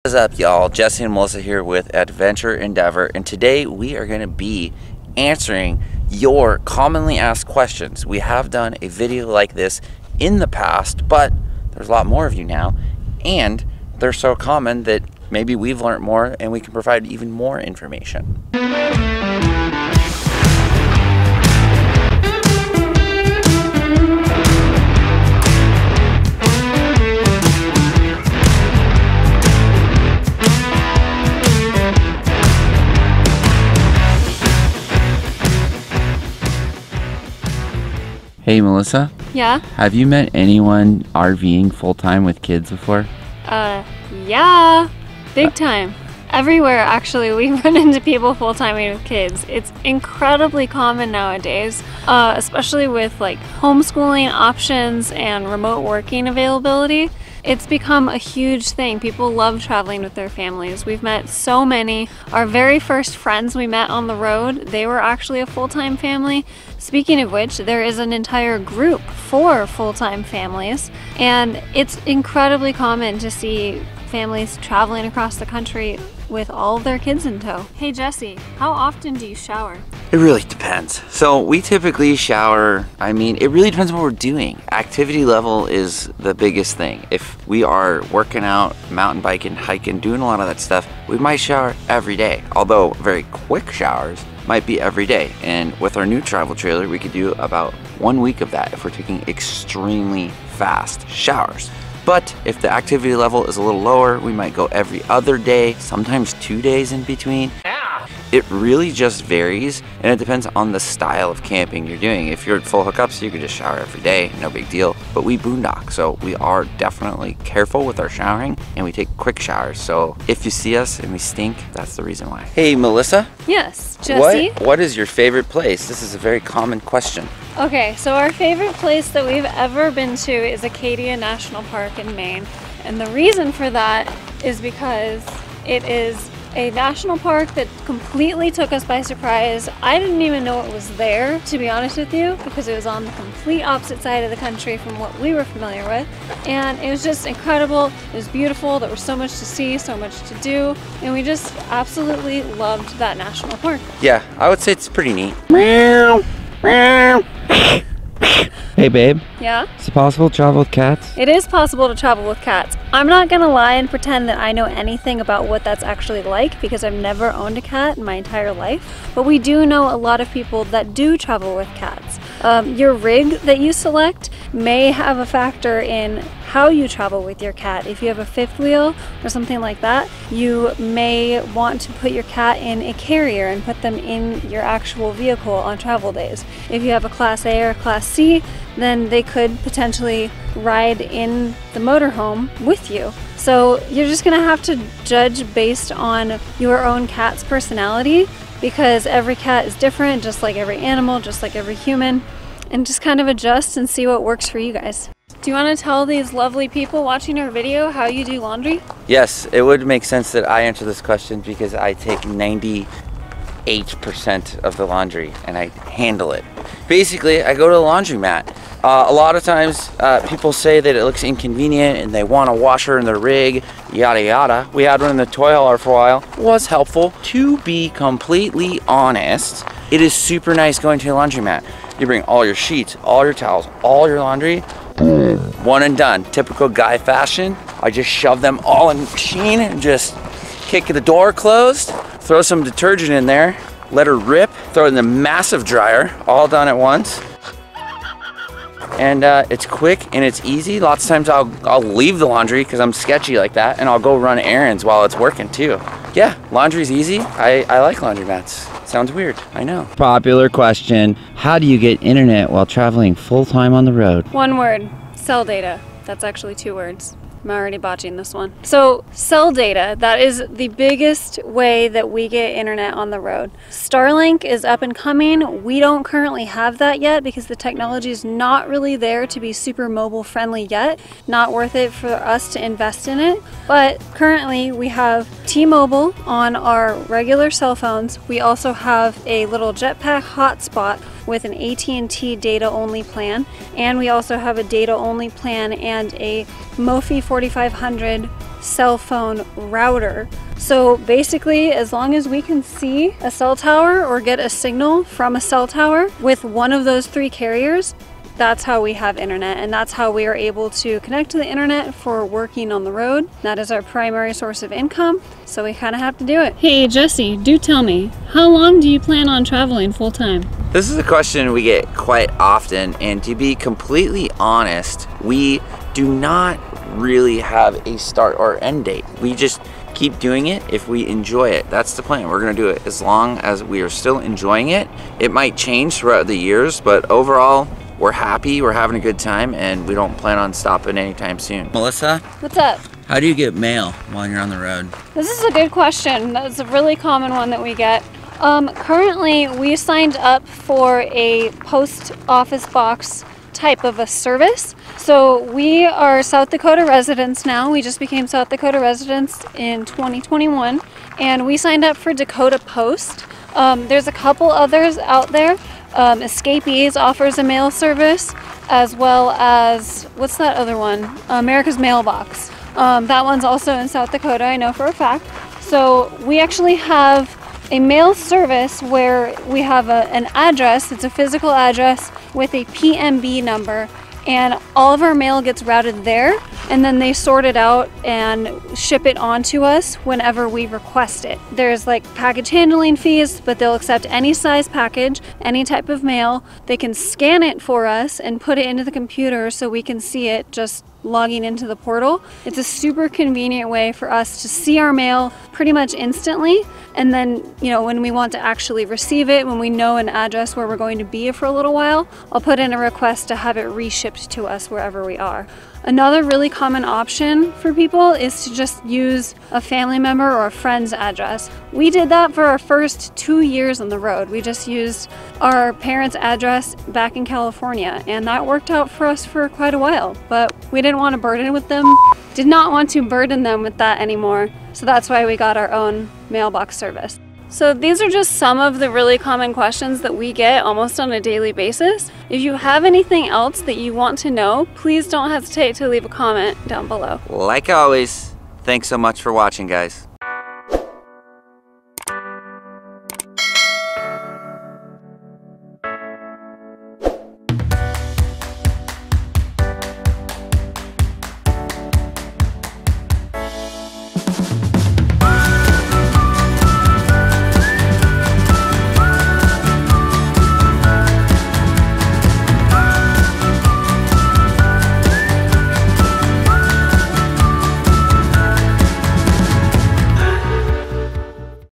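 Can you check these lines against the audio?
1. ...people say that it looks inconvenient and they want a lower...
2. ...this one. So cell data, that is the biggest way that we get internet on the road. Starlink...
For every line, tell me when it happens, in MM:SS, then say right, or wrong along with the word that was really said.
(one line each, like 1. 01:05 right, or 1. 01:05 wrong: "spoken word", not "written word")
1. 03:40 wrong: "washer", not "lower"
2. 04:28 right.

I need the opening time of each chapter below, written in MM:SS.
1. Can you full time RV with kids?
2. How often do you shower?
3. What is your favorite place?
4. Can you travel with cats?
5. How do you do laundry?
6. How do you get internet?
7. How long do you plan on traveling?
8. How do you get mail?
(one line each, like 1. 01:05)
1. 00:40
2. 01:18
3. 02:05
4. 02:40
5. 03:28
6. 04:21
7. 05:19
8. 05:44.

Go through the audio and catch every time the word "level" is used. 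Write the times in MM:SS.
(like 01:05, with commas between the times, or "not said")
01:25, 01:43.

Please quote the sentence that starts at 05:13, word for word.
That is our primary source of income, so we kind of have to do it.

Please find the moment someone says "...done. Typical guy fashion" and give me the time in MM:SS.
03:55.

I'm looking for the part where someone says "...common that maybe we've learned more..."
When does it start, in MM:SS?
00:14.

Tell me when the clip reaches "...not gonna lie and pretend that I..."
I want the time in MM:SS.
02:43.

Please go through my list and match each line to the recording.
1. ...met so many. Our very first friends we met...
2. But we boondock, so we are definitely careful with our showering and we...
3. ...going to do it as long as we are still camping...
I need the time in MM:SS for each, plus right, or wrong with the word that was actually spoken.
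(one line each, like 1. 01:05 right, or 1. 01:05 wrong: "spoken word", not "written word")
1. 01:01 right
2. 01:55 right
3. 05:32 wrong: "enjoying", not "camping".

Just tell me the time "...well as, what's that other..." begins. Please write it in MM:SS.
06:08.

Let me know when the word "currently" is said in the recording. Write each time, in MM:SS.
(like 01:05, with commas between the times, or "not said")
04:36, 04:44, 05:48.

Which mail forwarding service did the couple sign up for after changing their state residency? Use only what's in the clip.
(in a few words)
Dakota Post.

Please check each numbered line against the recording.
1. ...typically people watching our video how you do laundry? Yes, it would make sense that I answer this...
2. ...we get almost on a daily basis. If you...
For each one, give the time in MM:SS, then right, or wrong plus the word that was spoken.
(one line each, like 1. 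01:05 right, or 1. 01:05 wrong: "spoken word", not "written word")
1. 03:26 wrong: "lovely", not "typically"
2. 07:20 right.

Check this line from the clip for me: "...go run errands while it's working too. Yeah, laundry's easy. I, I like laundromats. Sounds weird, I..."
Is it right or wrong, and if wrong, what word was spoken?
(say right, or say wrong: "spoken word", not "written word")
right.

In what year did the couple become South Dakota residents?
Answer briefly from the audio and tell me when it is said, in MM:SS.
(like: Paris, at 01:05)
2021, at 05:59.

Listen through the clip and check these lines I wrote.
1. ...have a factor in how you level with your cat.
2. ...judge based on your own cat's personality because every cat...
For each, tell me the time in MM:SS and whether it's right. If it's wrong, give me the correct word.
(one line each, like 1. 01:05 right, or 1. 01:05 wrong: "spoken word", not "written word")
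1. 02:54 wrong: "travel", not "level"
2. 03:15 right.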